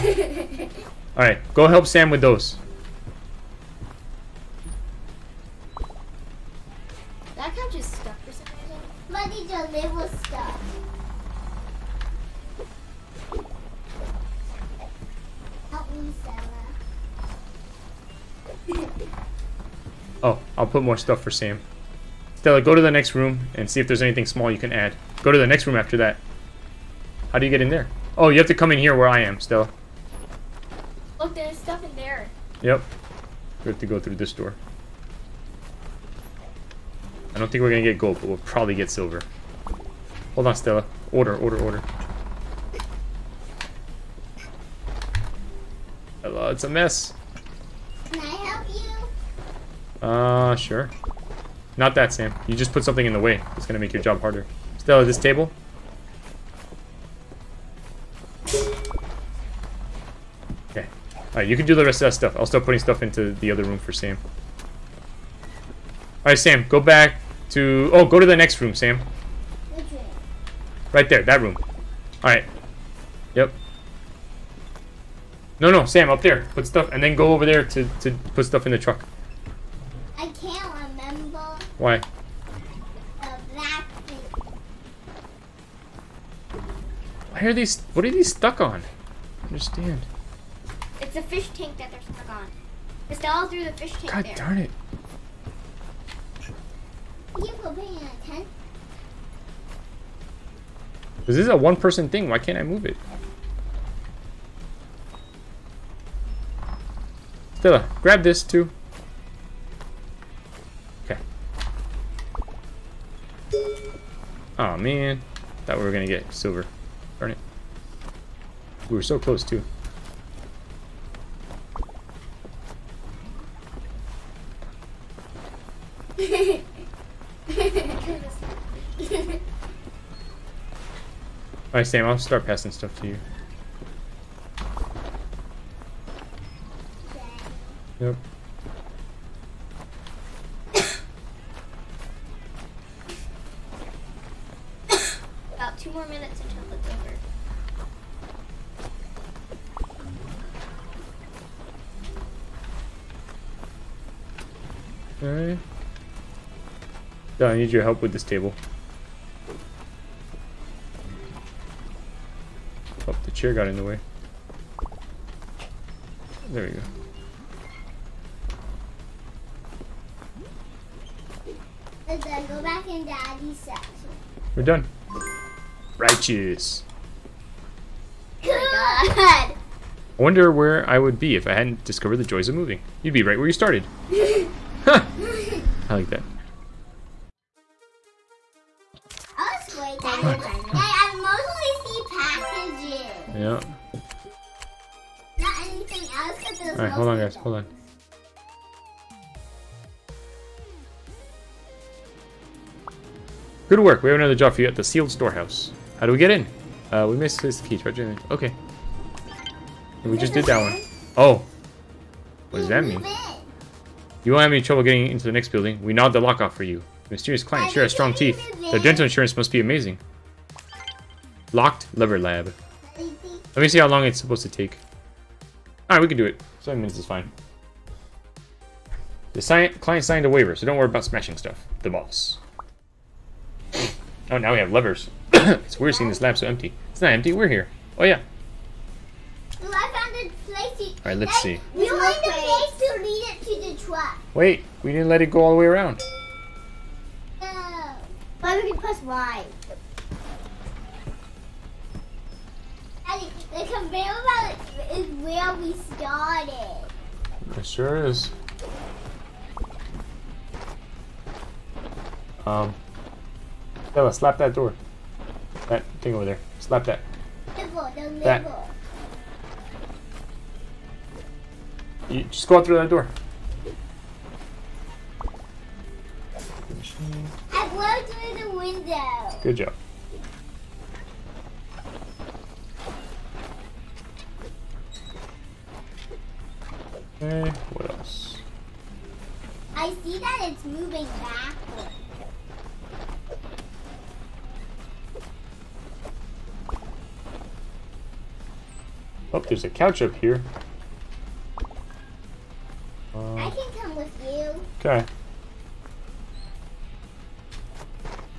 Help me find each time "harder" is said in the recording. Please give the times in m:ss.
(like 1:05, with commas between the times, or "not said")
0:54.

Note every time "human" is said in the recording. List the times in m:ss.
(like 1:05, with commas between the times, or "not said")
not said.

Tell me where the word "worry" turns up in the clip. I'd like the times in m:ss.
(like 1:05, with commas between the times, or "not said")
3:50.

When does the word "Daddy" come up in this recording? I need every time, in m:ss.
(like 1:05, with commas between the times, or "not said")
2:53, 4:13.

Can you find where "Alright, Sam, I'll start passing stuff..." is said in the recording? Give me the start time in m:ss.
2:11.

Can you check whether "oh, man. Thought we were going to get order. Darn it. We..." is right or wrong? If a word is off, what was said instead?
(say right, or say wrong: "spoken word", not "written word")
wrong: "silver", not "order".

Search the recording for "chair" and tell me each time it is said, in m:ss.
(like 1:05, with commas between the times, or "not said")
2:43.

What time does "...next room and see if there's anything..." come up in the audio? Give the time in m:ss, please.
0:22.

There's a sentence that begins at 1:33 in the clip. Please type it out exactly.
It's all through the fish tank.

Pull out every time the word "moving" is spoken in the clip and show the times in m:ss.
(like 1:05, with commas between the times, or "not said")
3:02, 4:50.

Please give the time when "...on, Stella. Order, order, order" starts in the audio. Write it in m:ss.
0:40.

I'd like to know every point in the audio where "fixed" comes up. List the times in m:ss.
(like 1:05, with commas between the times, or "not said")
not said.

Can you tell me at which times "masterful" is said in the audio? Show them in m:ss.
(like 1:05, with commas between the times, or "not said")
not said.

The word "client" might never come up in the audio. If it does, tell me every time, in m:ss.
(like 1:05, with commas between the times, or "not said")
3:37, 3:49.